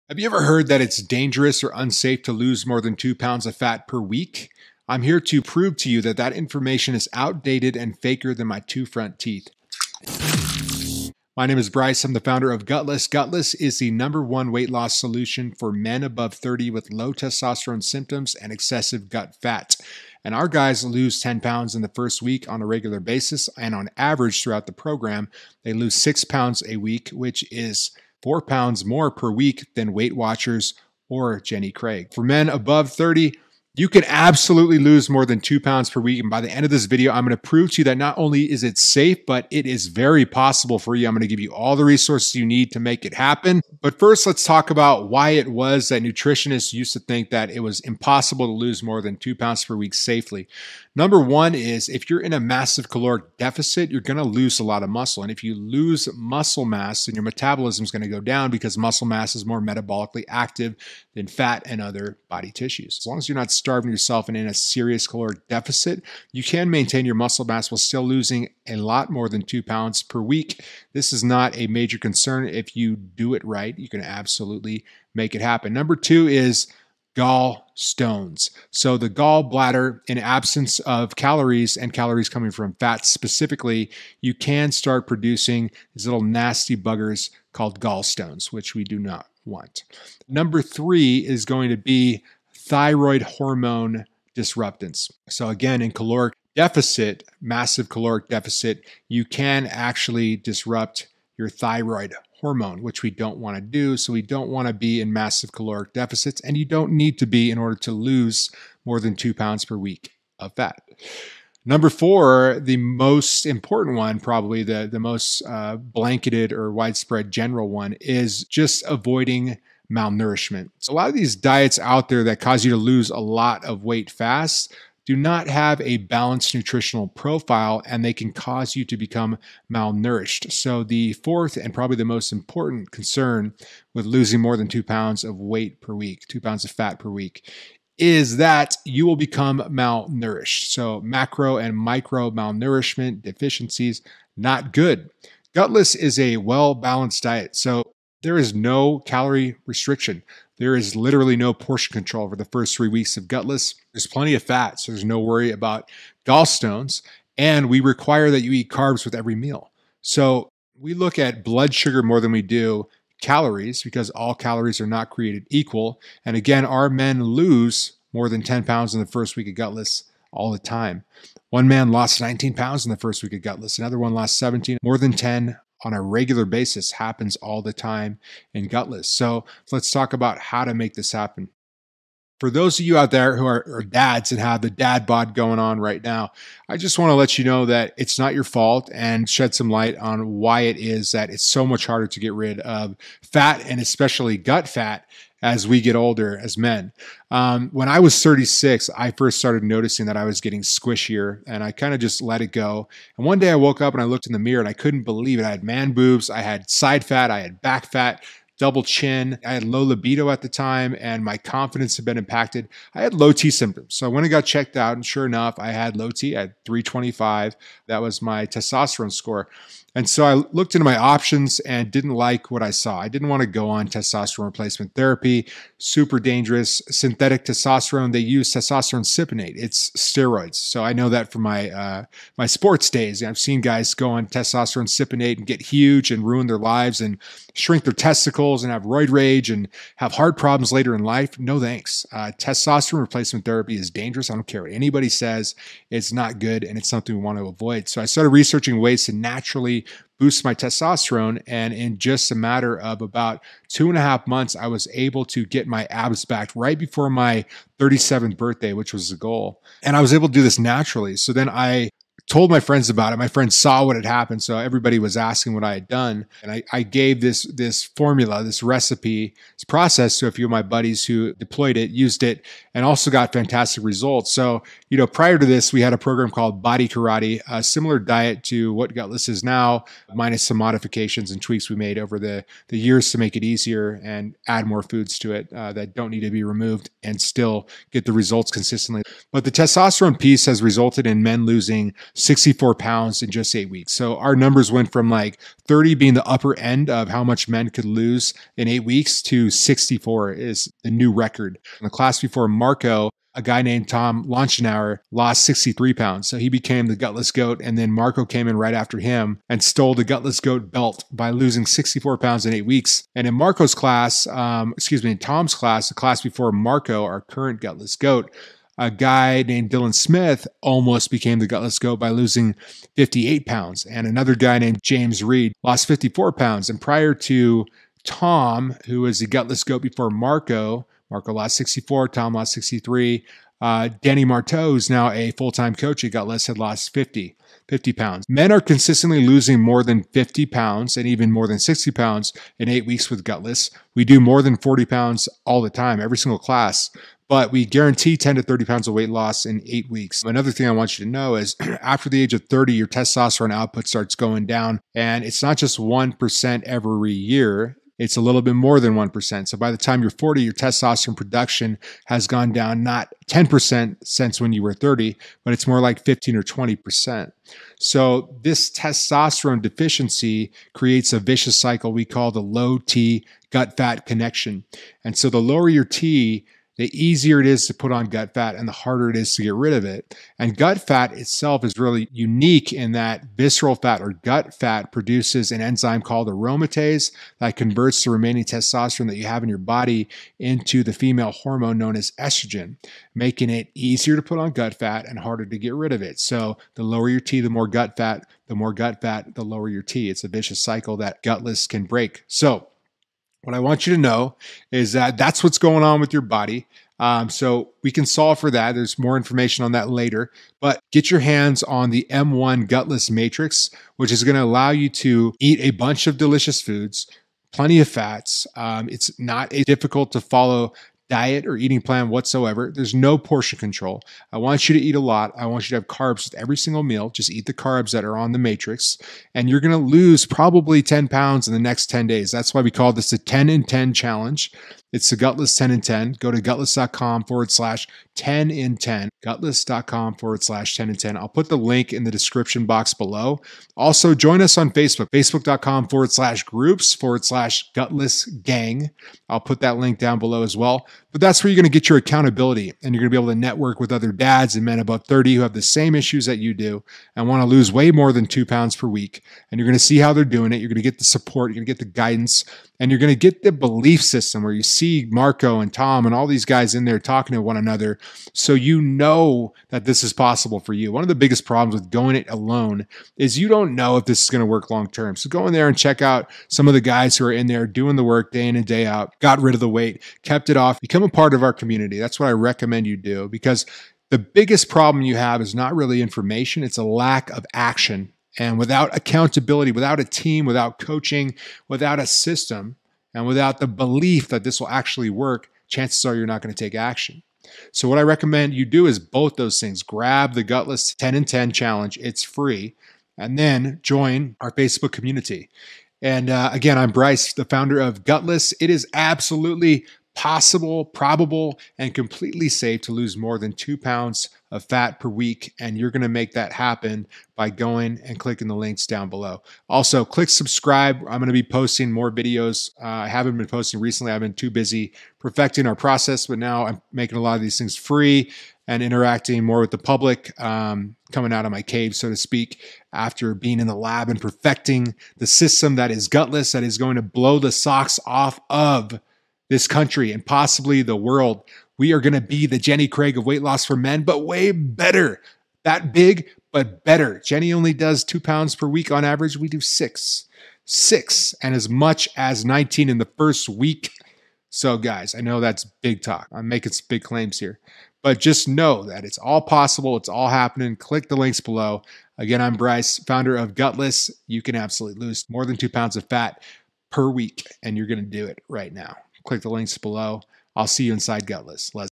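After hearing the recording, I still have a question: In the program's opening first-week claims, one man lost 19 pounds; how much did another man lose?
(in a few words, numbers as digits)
17.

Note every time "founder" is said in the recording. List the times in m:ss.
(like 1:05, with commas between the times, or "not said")
0:12, 8:27, 9:23.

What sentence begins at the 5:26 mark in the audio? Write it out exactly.
And prior to Tom, who was the gutless goat before Marco, Marco lost 64, Tom lost 63.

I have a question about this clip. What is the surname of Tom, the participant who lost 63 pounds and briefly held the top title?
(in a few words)
Launchenauer.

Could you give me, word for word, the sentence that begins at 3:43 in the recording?
I didn't want to go on testosterone replacement therapy, super dangerous.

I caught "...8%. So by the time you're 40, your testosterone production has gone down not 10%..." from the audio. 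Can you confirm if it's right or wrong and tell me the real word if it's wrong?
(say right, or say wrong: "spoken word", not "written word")
wrong: "1", not "8".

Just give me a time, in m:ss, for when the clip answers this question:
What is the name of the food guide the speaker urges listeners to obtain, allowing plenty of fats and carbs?
6:52.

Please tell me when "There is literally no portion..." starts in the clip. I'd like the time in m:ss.
2:30.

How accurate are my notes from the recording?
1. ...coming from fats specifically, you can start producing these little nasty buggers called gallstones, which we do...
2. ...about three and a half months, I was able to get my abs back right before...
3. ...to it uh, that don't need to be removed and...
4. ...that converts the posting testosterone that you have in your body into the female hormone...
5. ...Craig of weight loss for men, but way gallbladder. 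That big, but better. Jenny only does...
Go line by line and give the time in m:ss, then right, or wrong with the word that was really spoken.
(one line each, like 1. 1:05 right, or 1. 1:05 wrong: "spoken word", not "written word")
1. 1:22 right
2. 4:13 wrong: "two", not "three"
3. 4:45 right
4. 6:27 wrong: "remaining", not "posting"
5. 9:02 wrong: "better", not "gallbladder".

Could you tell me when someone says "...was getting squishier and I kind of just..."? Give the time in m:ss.
3:20.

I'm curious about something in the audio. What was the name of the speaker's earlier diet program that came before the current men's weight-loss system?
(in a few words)
Body Karate.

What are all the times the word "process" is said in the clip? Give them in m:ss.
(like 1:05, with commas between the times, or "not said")
4:29, 8:45.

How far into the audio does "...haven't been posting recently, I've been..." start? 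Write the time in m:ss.
8:43.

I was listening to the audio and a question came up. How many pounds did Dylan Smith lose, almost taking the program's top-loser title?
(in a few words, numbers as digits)
58.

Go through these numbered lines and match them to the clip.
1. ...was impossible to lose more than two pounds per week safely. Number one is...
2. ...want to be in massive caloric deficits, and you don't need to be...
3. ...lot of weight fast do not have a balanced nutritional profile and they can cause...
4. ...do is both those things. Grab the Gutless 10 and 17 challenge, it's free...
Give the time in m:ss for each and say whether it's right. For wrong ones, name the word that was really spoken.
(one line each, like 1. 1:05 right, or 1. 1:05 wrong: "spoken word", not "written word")
1. 0:47 right
2. 1:44 right
3. 2:03 right
4. 8:18 wrong: "10", not "17".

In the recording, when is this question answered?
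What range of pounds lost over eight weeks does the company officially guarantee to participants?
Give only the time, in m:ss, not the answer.
5:48.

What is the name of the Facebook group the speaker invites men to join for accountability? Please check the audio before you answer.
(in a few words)
Gutless Gang.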